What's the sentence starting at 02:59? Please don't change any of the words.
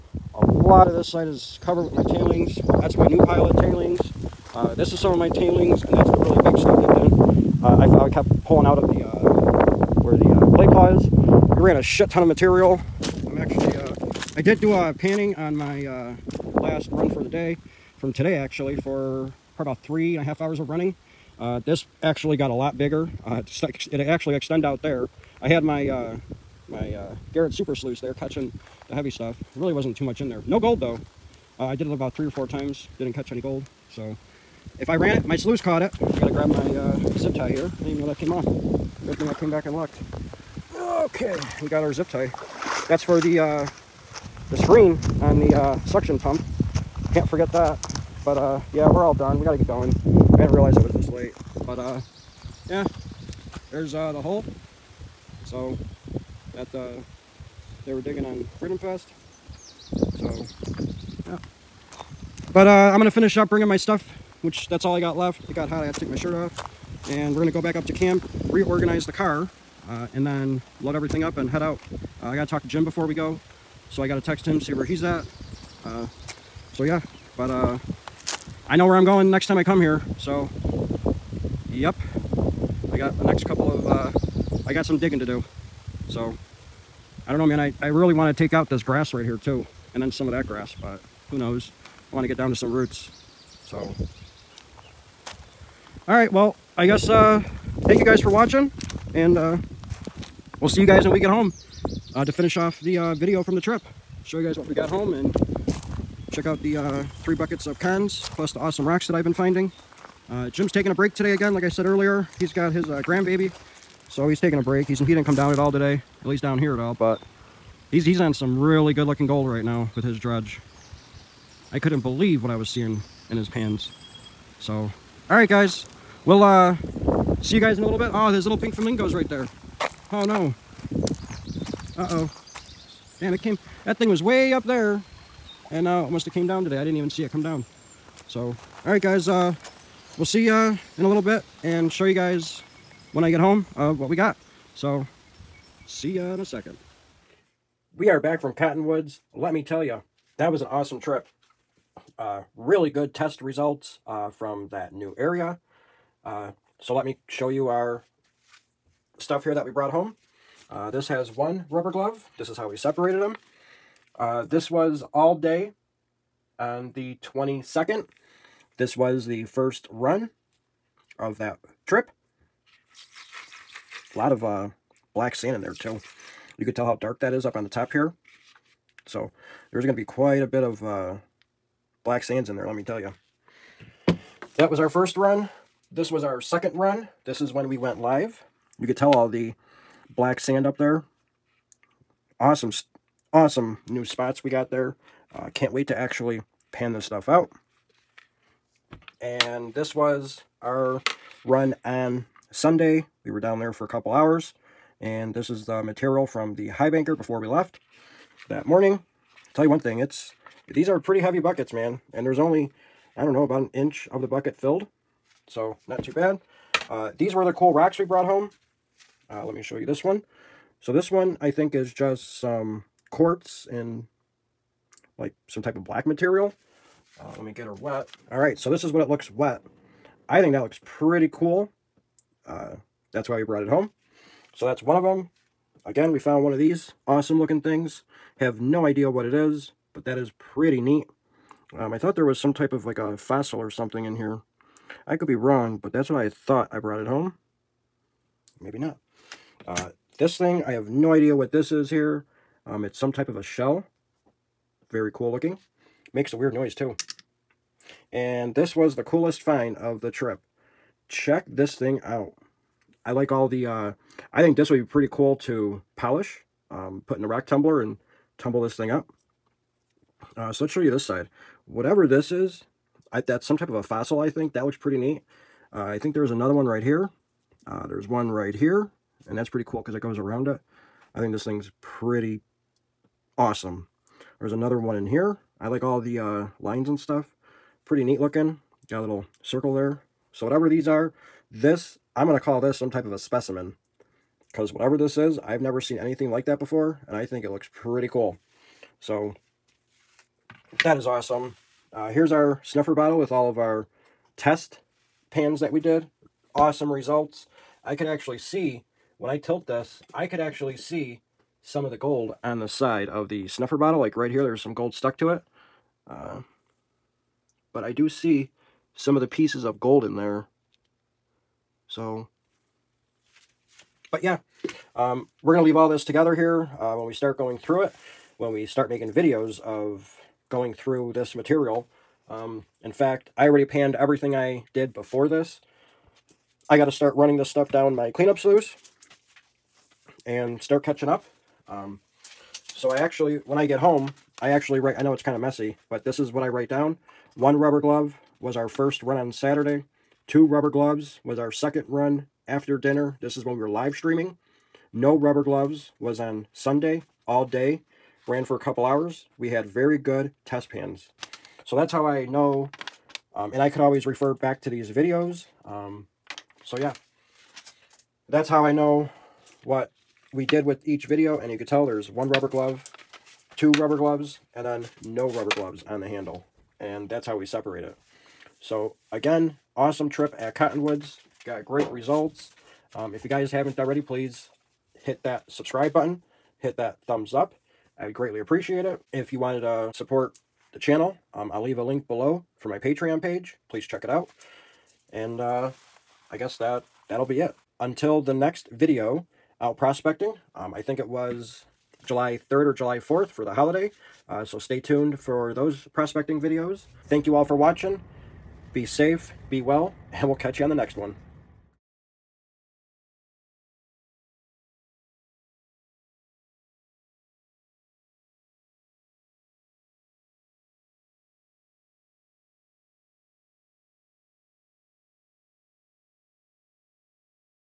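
So there's going to be quite a bit of uh, black sands in there, let me tell you.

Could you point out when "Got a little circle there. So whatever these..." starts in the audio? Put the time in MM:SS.
04:48.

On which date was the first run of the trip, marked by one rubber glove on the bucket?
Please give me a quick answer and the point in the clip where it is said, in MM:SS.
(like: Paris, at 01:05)
the 22nd, at 02:46.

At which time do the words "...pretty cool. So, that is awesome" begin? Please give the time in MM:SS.
04:57.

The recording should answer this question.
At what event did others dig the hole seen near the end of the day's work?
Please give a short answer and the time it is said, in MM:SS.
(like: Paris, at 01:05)
Freedom Fest, at 00:58.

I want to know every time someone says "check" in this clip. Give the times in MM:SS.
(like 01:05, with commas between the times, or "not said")
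01:46, 04:21, 06:33.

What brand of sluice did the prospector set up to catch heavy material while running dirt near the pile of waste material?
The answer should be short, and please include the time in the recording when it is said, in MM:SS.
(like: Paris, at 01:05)
Garrett Super Sluice, at 00:27.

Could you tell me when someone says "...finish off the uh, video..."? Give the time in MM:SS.
01:42.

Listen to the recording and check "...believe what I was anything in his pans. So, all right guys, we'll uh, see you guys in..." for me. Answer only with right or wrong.
wrong.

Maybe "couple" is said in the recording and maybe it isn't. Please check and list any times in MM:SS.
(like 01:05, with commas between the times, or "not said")
01:23, 03:23, 05:58.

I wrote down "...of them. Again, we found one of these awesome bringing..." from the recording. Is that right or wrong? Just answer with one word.
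wrong.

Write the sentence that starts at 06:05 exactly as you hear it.
Um, so yeah, that's how I know what we did with each video.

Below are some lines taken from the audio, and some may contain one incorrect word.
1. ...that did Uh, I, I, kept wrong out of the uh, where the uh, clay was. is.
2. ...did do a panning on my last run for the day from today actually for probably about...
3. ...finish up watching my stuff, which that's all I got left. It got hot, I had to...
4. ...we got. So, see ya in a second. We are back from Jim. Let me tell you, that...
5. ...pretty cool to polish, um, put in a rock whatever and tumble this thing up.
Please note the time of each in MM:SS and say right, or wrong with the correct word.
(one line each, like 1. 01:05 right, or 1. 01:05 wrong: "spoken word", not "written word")
1. 00:06 wrong: "pulling", not "wrong"
2. 00:14 right
3. 01:03 wrong: "bringing", not "watching"
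4. 02:24 wrong: "Cottonwoods", not "Jim"
5. 04:24 wrong: "tumbler", not "whatever".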